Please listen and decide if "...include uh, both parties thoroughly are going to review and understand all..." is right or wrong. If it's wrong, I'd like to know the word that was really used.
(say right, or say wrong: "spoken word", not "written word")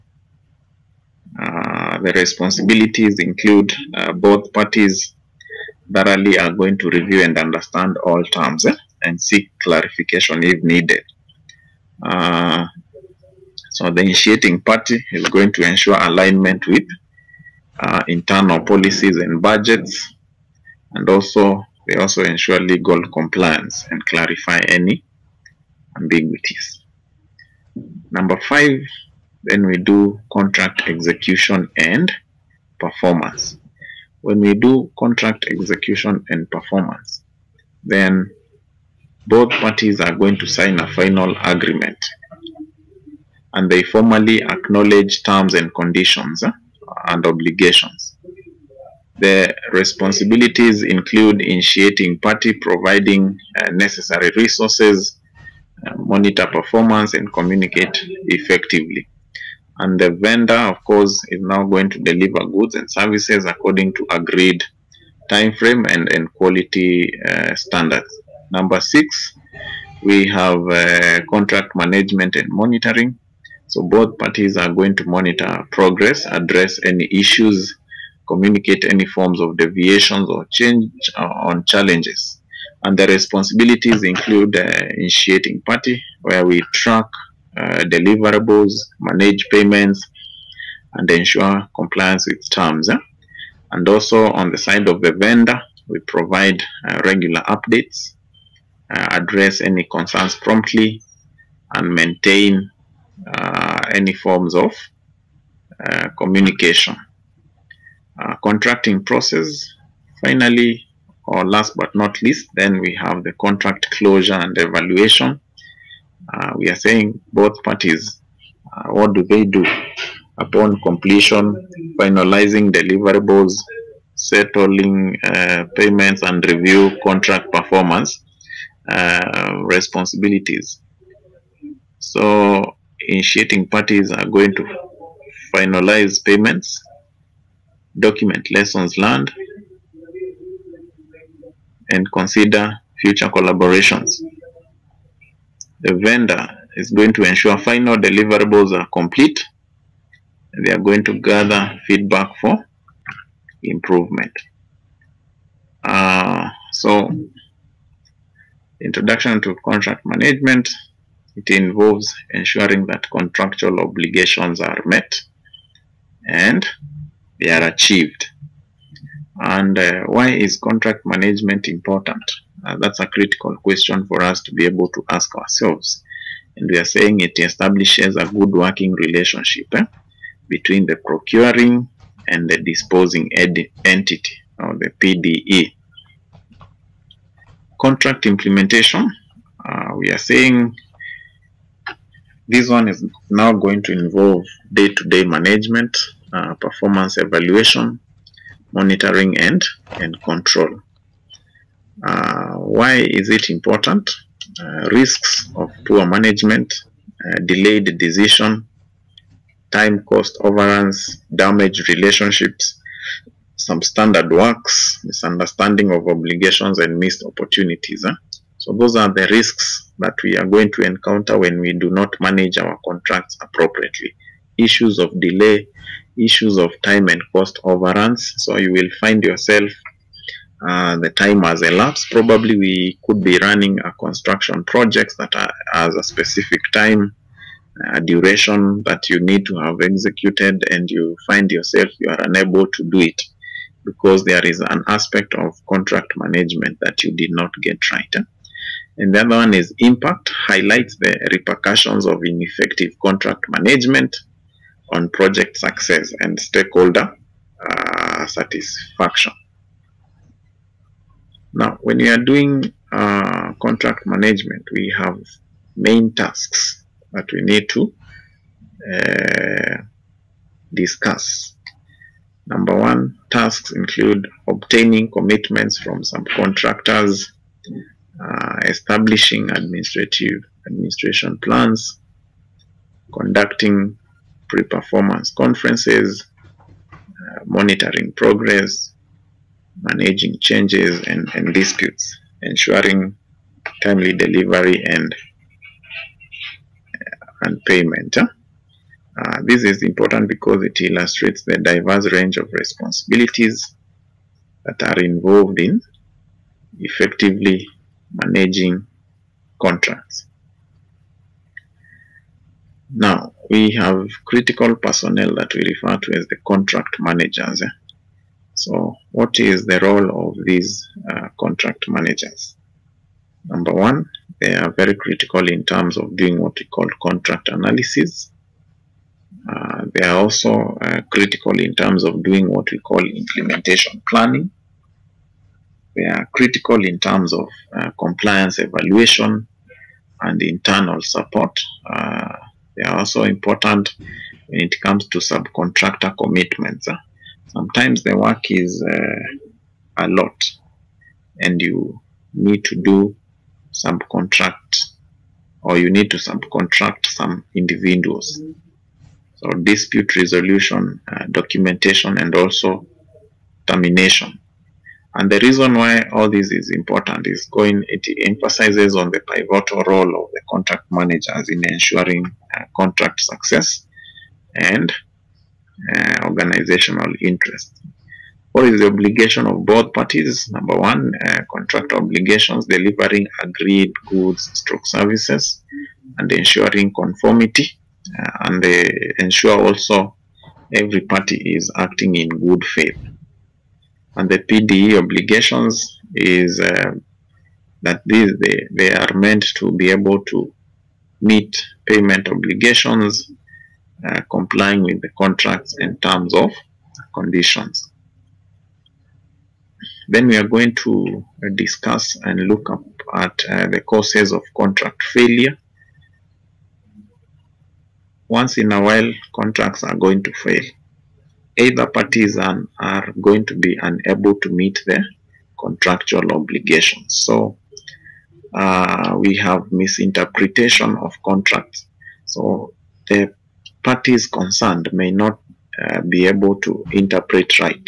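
right.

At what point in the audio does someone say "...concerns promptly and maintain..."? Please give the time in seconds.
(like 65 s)
99 s.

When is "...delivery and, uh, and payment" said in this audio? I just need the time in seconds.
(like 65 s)
294 s.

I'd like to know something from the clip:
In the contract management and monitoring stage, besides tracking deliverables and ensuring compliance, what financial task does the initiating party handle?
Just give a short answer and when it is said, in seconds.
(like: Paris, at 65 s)
manage payments, at 89 s.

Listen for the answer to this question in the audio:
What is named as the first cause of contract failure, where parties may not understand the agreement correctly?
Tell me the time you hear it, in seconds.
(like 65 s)
429 s.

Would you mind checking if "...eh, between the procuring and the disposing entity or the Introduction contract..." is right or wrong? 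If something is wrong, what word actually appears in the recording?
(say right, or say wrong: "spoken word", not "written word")
wrong: "PDE", not "Introduction".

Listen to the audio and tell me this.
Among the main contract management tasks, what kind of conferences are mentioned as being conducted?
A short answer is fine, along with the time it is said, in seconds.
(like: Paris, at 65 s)
pre-performance conferences, at 284 s.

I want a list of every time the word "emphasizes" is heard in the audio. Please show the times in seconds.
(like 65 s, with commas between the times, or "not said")
368 s.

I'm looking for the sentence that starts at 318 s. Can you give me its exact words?
So, what is the role of these uh, contract managers?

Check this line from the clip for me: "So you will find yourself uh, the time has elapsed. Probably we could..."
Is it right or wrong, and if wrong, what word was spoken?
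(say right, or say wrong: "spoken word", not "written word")
right.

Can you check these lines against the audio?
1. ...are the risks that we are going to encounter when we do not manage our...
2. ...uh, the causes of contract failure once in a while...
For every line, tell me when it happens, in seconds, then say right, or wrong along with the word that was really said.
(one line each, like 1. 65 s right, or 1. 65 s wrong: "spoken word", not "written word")
1. 218 s right
2. 413 s right.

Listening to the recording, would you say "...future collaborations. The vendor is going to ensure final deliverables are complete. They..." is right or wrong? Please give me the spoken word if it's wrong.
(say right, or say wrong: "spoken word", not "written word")
right.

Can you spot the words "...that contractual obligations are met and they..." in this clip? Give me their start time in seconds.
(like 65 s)
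162 s.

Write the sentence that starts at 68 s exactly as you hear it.
Number six, we have uh, contract management and monitoring.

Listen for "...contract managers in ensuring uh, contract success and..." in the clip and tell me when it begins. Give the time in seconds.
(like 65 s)
370 s.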